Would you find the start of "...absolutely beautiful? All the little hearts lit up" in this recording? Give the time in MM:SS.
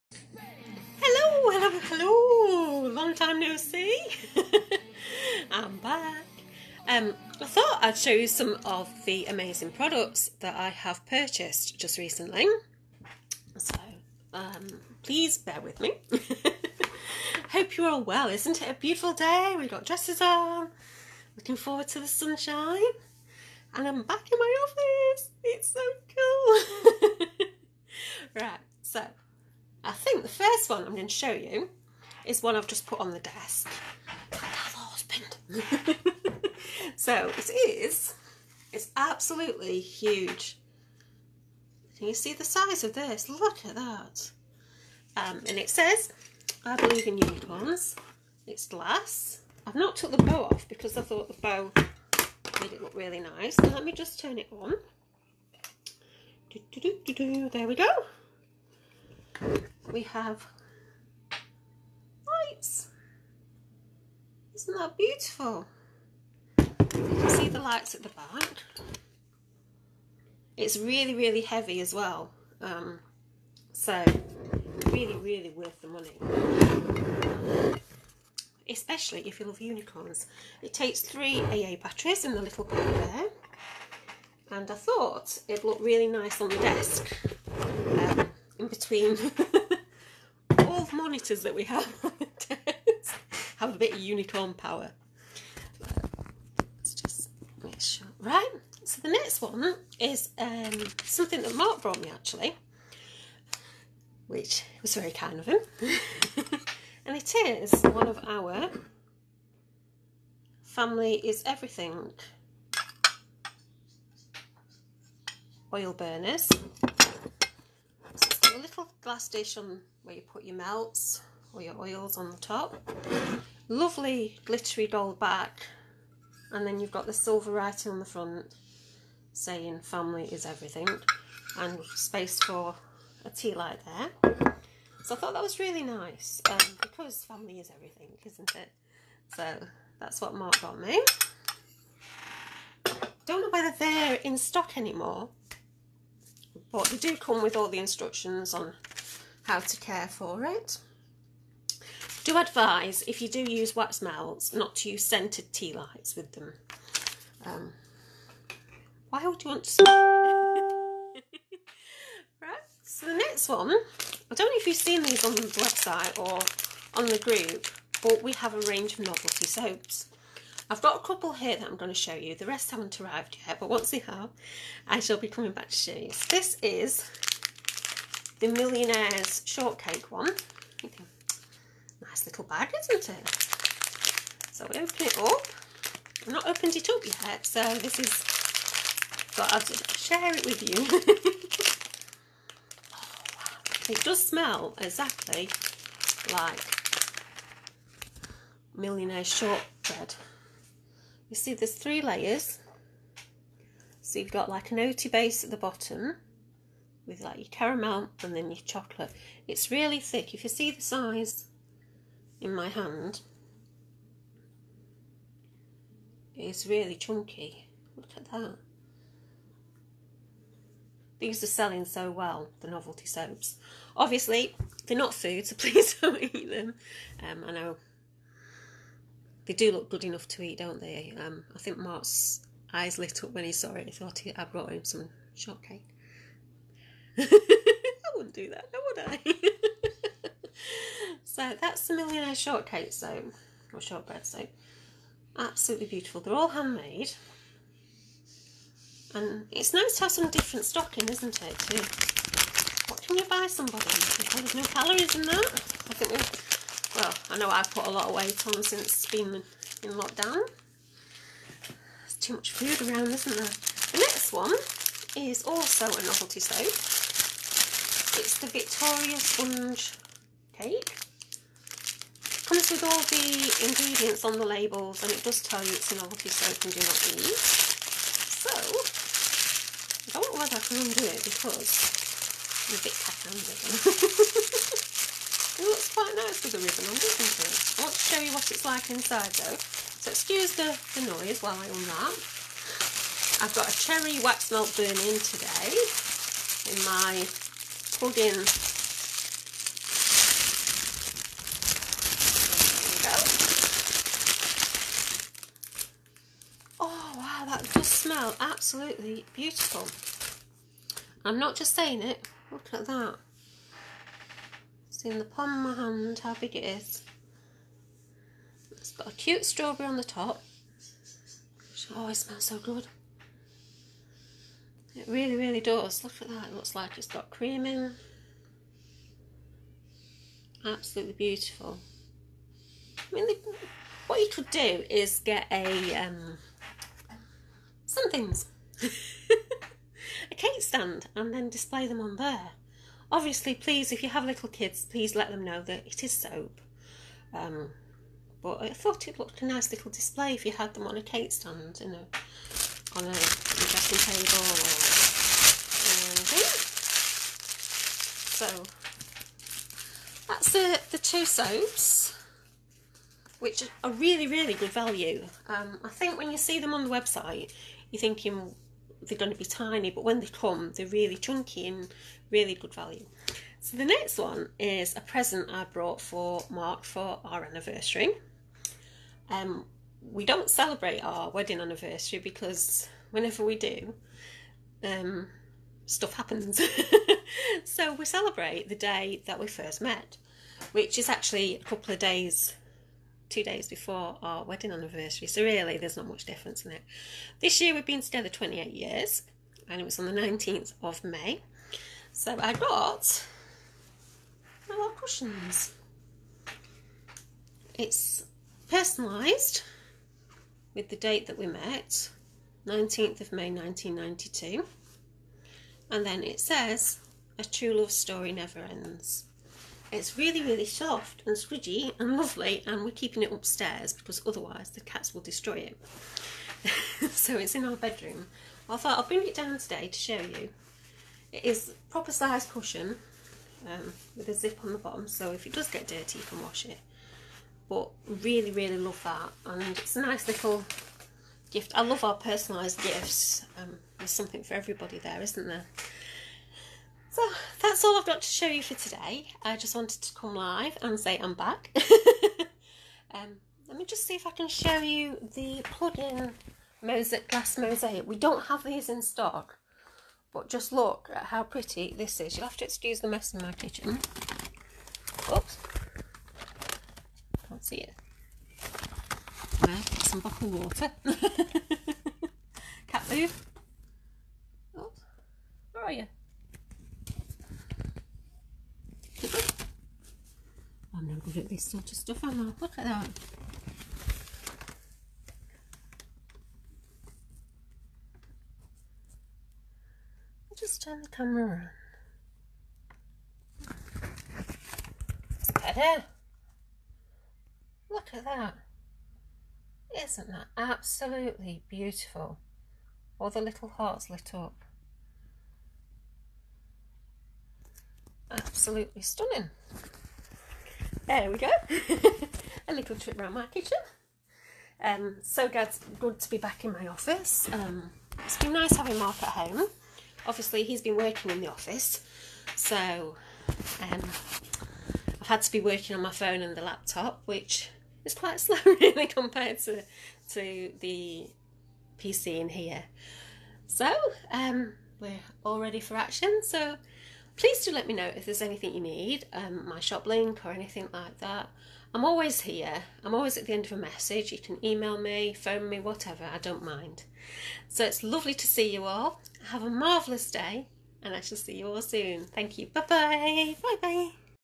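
08:20.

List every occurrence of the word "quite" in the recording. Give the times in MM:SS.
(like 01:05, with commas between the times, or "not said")
04:45, 08:48.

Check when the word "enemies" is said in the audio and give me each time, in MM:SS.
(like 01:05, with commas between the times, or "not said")
not said.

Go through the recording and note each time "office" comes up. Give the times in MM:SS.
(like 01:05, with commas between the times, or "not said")
00:24, 08:36, 08:41.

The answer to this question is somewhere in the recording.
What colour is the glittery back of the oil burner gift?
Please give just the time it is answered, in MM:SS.
02:04.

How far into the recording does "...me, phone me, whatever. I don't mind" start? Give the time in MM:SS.
09:04.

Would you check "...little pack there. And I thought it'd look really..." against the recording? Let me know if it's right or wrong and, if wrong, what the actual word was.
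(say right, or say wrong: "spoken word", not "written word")
right.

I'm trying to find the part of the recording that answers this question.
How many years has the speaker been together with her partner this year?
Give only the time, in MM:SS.
06:38.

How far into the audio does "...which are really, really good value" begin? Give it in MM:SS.
06:03.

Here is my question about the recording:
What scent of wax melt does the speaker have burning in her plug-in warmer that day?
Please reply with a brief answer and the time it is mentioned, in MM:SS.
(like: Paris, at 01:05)
Cherry, at 04:53.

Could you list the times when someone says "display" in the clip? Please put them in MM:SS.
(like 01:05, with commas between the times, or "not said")
05:41, 05:49.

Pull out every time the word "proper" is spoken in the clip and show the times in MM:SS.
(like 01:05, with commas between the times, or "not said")
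07:11.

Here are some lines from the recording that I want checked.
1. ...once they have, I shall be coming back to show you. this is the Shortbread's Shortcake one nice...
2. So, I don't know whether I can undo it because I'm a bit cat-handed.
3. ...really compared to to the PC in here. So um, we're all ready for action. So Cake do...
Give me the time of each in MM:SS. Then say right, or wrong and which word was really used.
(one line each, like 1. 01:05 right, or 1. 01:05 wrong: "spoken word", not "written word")
1. 02:53 wrong: "Millionaire", not "Shortbread"
2. 04:37 right
3. 08:48 wrong: "Please", not "Cake".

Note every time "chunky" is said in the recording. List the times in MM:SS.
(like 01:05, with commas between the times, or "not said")
03:36, 06:11.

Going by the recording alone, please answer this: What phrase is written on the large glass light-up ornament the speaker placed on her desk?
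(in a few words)
I believe in unicorns.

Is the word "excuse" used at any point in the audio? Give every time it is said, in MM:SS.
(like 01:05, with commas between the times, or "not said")
04:50, 07:42.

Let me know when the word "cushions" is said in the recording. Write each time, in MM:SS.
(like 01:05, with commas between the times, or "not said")
06:44, 07:12.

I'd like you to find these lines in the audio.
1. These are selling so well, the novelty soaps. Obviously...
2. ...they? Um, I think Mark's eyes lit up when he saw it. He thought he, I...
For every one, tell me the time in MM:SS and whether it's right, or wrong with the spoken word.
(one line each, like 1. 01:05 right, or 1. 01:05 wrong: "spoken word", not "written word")
1. 03:41 right
2. 03:50 right.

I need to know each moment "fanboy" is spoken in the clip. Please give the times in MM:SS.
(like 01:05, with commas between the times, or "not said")
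not said.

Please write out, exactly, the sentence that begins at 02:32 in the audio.
Do advise, if you do use wax melts, not to use scented tea lights with them.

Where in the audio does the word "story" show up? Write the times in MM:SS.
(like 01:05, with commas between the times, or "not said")
06:57.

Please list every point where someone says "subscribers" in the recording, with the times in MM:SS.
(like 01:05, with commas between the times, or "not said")
not said.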